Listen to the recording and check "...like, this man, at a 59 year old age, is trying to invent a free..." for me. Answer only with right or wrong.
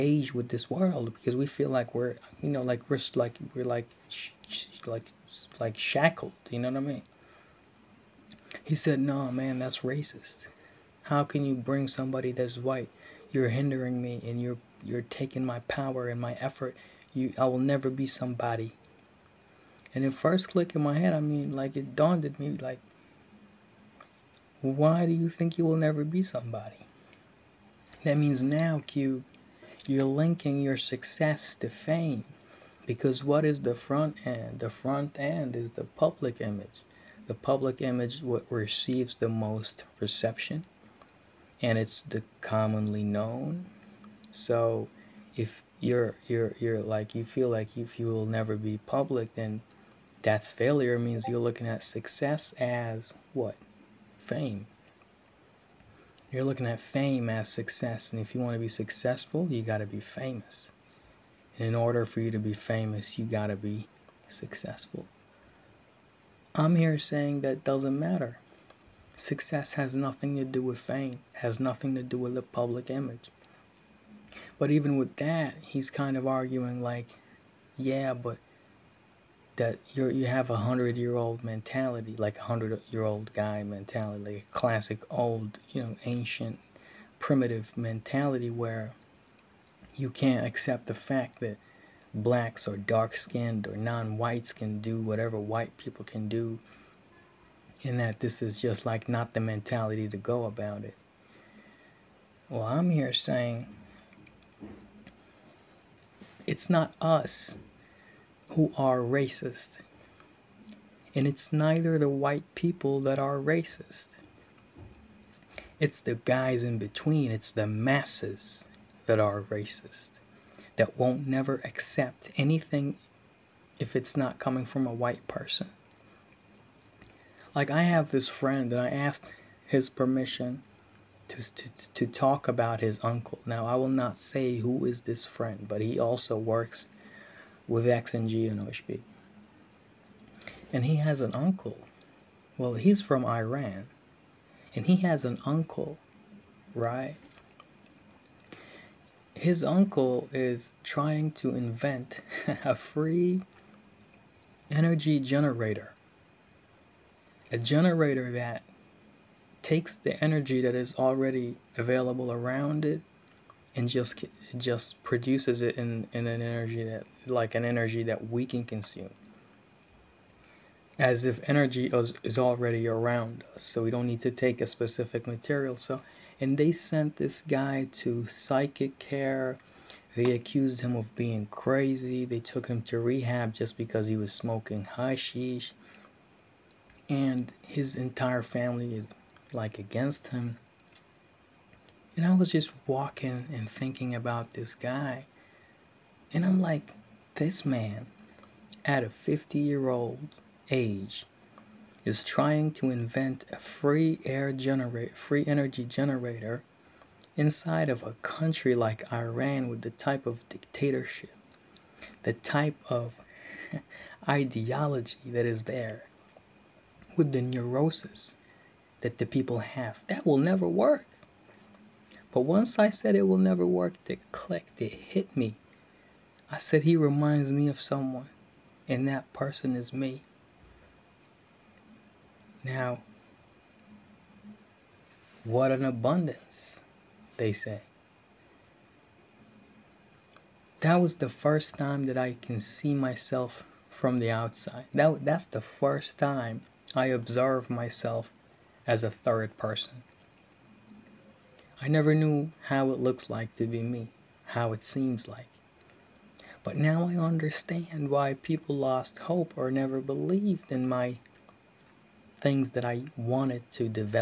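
wrong.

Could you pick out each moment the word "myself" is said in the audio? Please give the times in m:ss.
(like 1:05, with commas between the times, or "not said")
4:02, 4:07.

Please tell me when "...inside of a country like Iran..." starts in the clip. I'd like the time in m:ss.
3:27.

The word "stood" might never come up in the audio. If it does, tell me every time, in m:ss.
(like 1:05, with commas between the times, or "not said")
not said.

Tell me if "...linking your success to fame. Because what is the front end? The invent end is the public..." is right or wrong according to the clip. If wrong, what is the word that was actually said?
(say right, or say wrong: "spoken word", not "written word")
wrong: "front", not "invent".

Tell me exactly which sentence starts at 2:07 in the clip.
Like, I have this friend, and I asked his permission to, to, to talk about his uncle.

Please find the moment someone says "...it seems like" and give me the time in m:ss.
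4:14.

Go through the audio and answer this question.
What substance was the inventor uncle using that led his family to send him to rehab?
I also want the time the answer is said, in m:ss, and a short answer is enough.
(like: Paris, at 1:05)
Hashish, at 3:04.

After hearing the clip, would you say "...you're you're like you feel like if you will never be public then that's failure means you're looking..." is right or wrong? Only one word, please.
right.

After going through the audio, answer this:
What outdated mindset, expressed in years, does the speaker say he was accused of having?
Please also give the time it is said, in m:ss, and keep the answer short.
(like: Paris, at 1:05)
hundred year old mentality, at 1:20.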